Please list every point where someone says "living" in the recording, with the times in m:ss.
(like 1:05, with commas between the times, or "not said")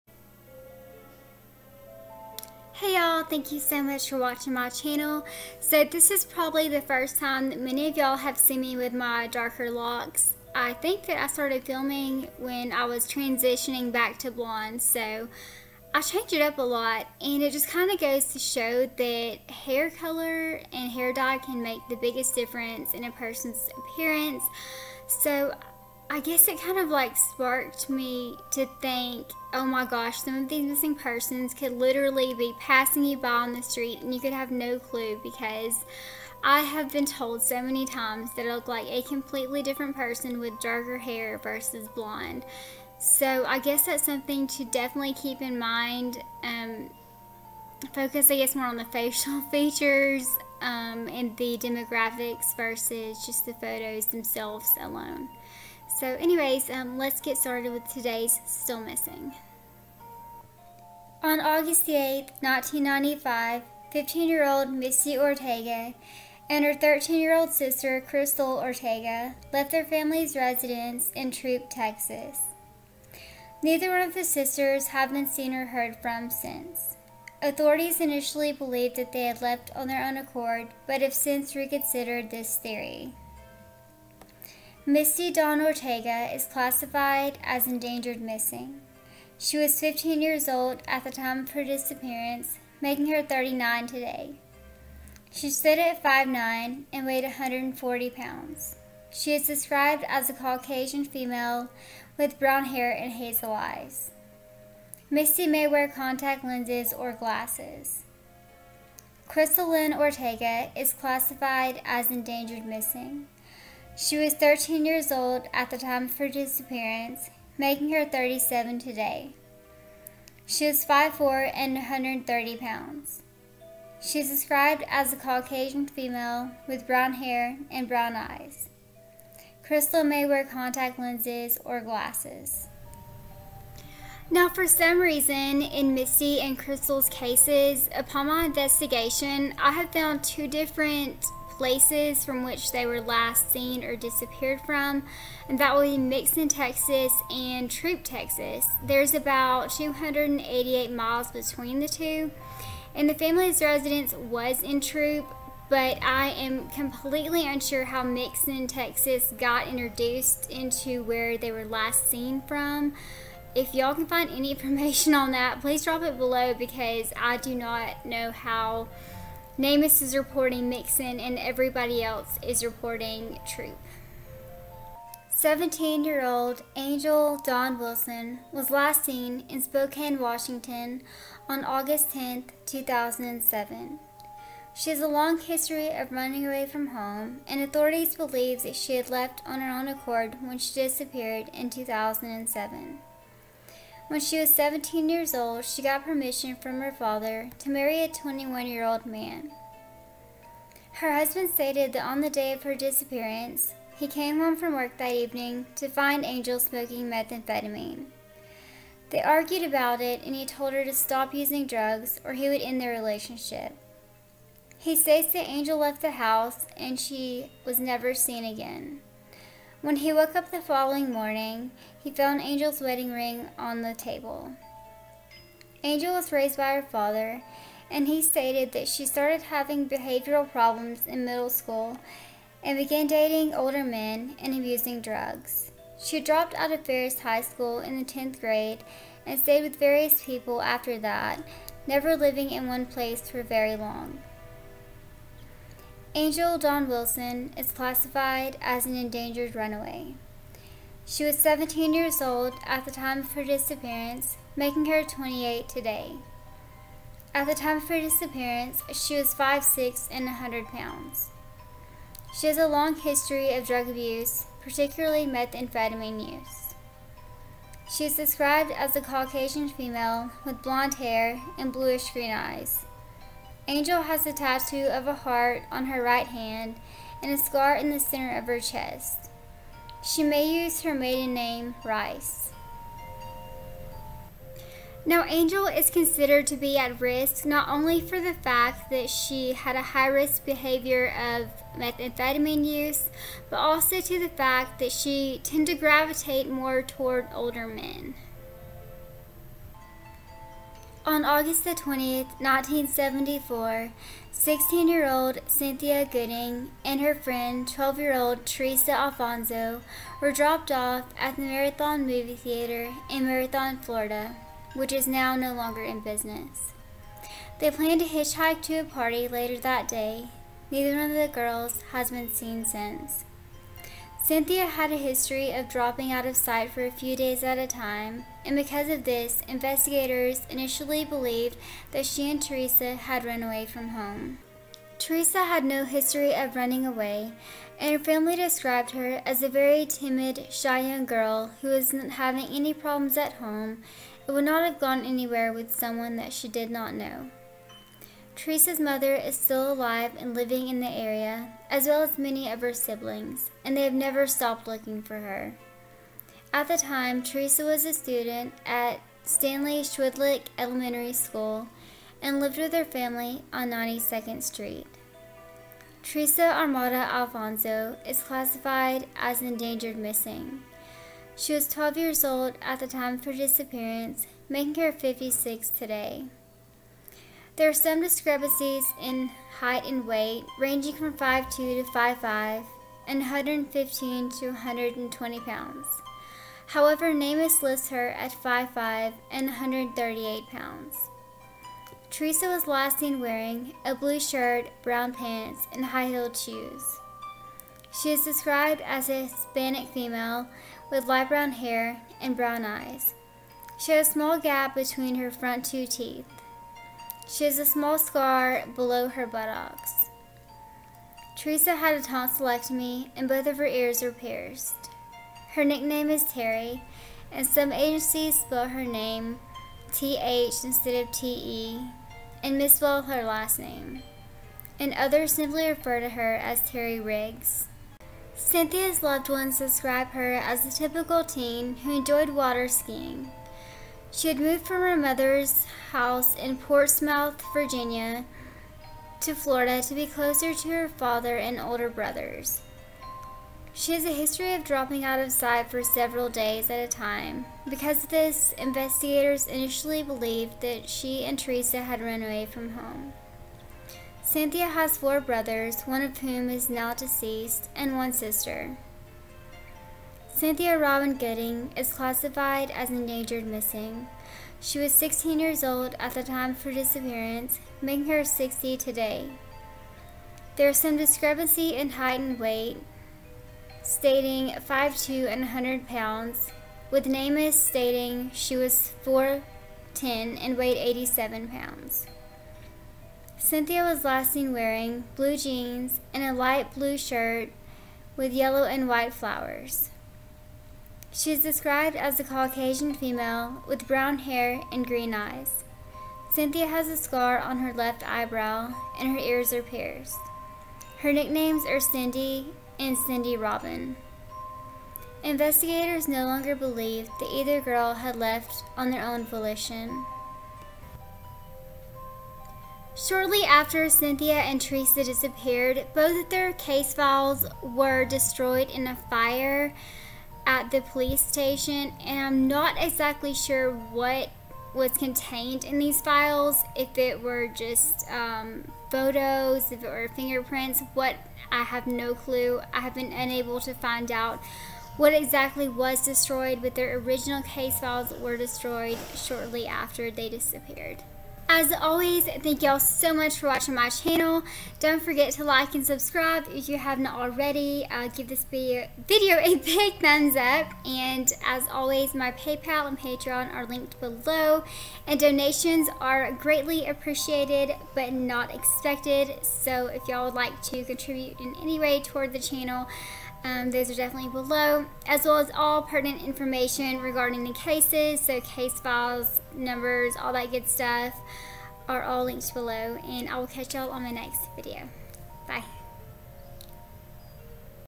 4:02, 5:50.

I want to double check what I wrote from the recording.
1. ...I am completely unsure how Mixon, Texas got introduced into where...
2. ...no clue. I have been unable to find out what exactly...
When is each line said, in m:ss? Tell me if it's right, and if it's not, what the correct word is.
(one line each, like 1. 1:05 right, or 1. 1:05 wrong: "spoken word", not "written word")
1. 2:36 right
2. 8:51 right.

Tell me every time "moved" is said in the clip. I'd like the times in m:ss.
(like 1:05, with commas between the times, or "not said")
7:14.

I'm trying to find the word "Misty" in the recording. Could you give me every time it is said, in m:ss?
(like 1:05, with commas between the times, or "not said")
1:04, 1:24, 1:45, 2:15.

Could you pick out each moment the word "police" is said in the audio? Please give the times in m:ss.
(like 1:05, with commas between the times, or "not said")
8:40.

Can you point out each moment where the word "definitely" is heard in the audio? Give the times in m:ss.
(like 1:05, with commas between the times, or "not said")
0:44, 9:23.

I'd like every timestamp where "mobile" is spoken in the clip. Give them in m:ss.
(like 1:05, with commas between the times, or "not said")
not said.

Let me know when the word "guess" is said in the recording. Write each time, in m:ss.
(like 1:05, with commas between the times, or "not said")
0:26, 0:43, 0:48.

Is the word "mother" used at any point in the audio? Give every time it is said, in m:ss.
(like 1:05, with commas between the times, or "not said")
5:48, 7:14.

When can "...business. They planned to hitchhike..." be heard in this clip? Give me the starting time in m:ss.
5:16.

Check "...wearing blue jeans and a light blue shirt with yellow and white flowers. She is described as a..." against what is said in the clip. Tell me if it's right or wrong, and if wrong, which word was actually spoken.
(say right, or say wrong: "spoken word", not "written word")
right.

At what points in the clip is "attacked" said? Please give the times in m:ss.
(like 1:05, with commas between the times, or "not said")
not said.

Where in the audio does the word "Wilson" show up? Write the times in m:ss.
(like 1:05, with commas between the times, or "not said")
2:57, 4:06.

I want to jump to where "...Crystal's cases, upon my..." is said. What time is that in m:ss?
2:16.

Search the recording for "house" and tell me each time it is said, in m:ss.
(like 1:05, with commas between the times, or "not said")
3:36, 7:15.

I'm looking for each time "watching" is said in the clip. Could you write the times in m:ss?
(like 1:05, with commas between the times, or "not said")
0:04, 9:03.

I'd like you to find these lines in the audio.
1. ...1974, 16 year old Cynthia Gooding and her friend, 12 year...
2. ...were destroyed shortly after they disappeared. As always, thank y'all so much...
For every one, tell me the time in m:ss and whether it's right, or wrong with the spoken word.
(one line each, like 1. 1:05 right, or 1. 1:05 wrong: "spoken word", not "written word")
1. 5:02 right
2. 8:58 right.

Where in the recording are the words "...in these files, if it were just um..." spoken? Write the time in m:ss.
8:45.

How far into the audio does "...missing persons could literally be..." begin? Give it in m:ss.
0:30.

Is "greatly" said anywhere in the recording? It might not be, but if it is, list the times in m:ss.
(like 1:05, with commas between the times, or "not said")
9:16.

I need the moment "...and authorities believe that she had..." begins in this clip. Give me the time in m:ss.
3:07.